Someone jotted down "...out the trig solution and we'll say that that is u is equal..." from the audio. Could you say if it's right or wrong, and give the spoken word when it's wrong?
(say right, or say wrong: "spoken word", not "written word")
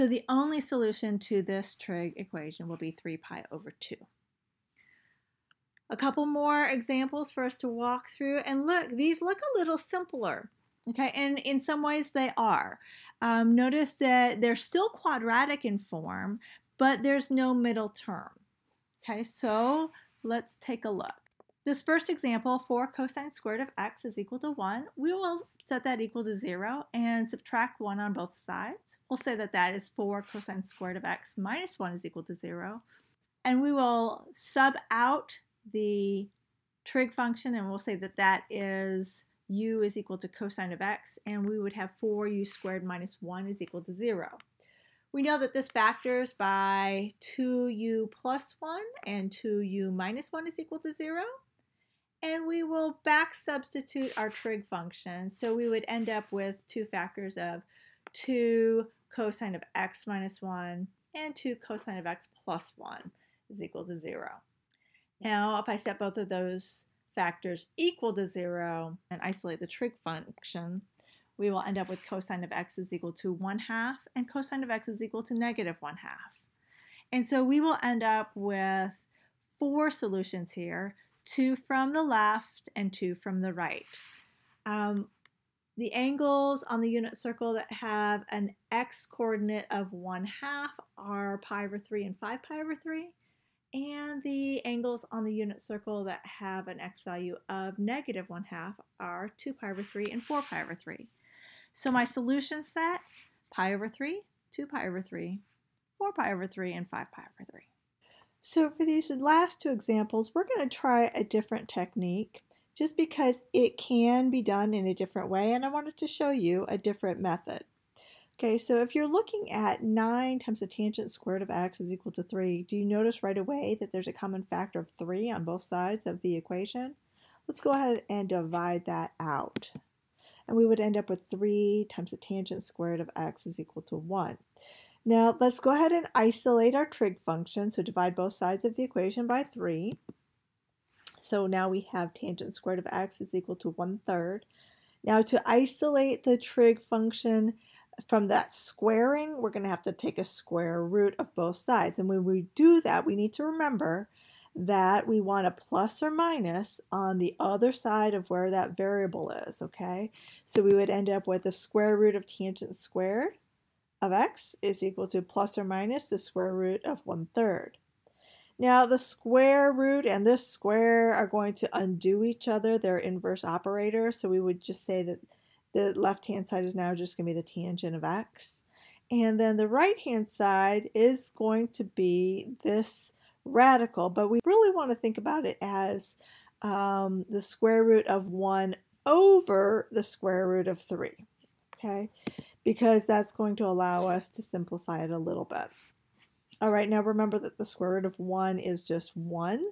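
wrong: "function", not "solution".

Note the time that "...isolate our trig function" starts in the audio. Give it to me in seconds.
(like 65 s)
136 s.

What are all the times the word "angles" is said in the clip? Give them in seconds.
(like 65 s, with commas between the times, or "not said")
85 s, 94 s.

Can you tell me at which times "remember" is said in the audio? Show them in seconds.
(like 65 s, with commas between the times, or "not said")
153 s, 197 s.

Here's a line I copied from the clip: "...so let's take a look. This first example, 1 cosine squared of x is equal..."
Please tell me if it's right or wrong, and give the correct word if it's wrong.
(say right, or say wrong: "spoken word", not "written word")
wrong: "4", not "1".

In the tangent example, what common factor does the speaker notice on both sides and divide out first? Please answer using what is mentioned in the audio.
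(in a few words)
3.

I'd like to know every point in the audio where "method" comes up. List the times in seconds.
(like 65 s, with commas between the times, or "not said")
117 s.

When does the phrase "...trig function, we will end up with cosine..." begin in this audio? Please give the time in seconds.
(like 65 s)
69 s.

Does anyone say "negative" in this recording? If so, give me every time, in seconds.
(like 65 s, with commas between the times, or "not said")
75 s, 97 s.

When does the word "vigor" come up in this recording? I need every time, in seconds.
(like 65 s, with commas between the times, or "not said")
not said.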